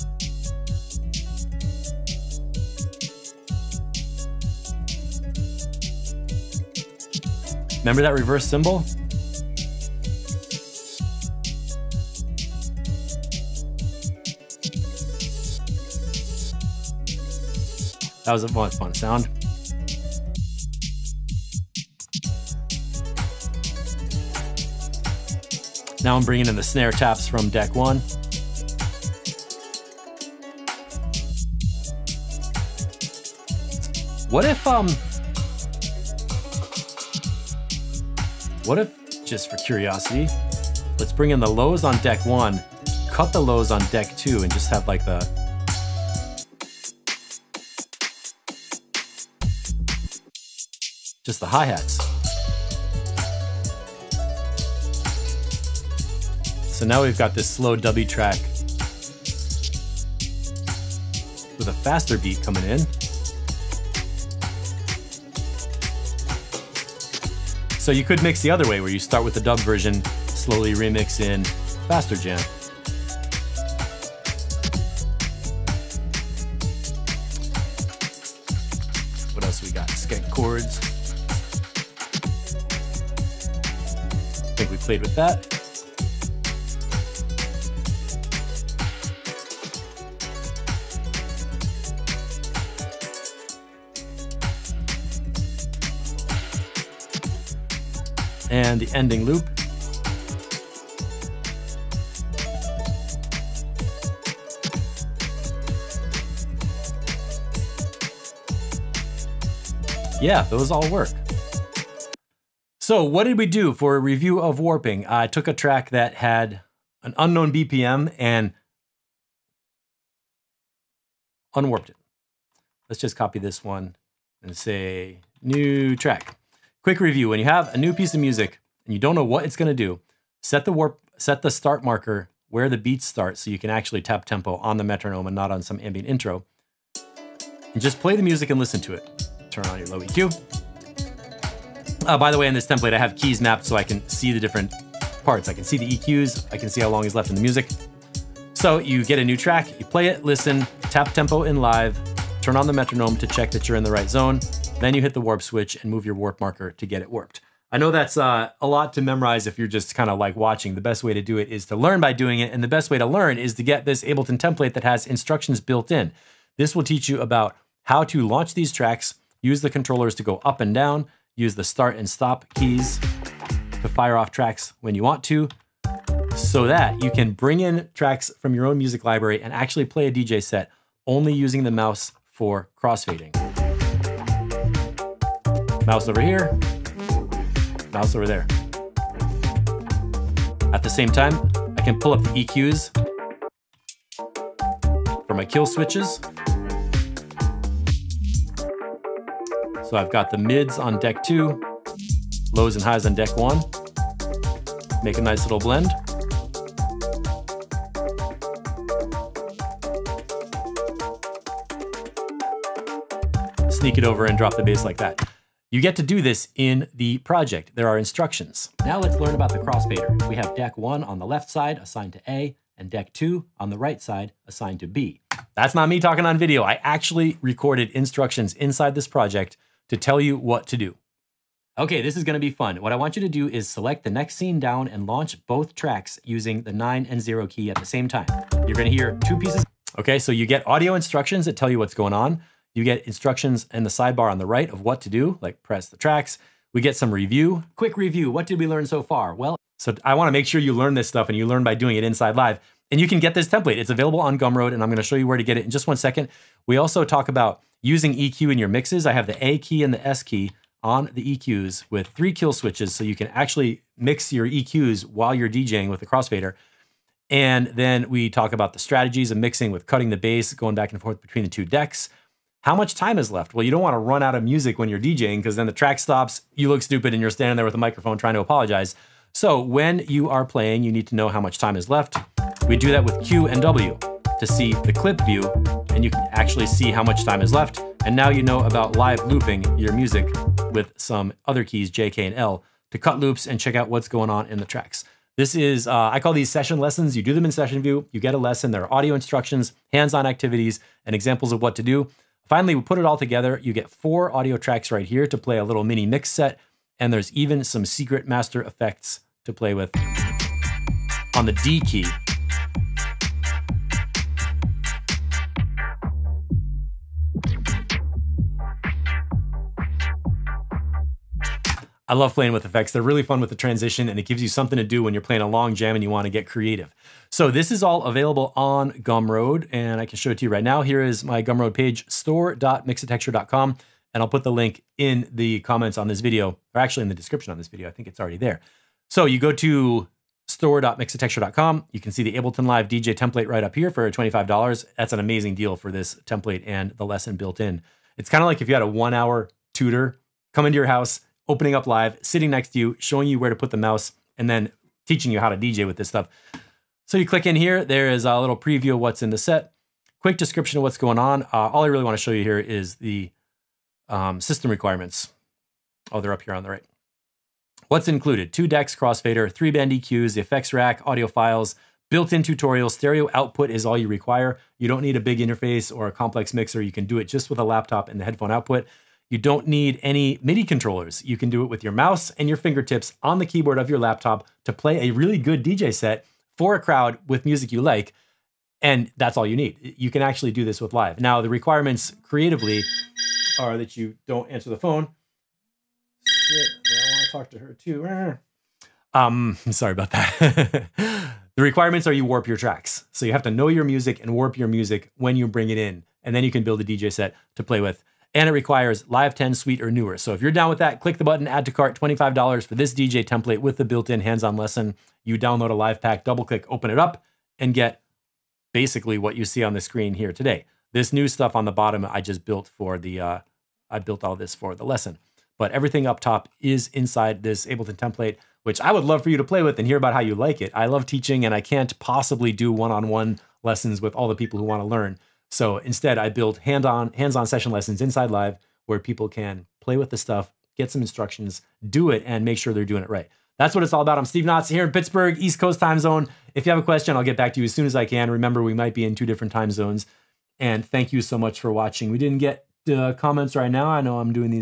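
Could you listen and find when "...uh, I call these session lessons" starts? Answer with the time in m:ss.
4:55.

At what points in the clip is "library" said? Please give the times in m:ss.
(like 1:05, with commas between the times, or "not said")
2:59.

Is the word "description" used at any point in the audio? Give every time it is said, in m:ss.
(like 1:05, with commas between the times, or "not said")
5:37, 6:00.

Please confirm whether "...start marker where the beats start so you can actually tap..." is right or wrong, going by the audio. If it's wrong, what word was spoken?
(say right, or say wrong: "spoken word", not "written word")
right.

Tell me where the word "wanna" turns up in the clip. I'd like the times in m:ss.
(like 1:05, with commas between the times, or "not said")
4:10, 6:02, 7:14.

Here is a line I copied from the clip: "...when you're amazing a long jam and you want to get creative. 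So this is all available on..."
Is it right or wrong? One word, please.
wrong.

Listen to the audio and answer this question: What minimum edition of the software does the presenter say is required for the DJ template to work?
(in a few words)
Live 10 Suite.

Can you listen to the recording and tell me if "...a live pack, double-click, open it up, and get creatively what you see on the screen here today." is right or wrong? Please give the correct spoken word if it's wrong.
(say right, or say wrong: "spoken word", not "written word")
wrong: "basically", not "creatively".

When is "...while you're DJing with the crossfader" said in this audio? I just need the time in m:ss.
4:25.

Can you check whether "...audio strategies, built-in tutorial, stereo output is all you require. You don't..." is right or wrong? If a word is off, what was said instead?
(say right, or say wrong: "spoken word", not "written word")
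wrong: "files", not "strategies".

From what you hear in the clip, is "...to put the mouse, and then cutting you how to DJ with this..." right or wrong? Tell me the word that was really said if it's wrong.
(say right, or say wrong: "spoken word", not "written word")
wrong: "teaching", not "cutting".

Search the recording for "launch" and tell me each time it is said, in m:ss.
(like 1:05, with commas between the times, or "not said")
2:48, 3:55.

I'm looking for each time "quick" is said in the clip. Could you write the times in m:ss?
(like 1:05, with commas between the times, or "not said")
2:06, 4:07, 6:00.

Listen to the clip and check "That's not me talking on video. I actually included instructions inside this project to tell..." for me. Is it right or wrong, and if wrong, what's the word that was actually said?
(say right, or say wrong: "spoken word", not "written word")
wrong: "recorded", not "included".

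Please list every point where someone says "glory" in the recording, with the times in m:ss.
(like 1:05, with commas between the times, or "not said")
not said.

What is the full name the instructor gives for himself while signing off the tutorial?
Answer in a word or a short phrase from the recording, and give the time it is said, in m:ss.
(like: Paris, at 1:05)
Steve Knotts, at 7:24.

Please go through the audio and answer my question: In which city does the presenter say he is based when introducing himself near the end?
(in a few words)
Pittsburgh.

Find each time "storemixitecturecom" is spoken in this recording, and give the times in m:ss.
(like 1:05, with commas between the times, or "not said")
5:32, 5:40.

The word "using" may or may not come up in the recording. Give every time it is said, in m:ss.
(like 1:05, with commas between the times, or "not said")
3:01, 3:56, 4:17.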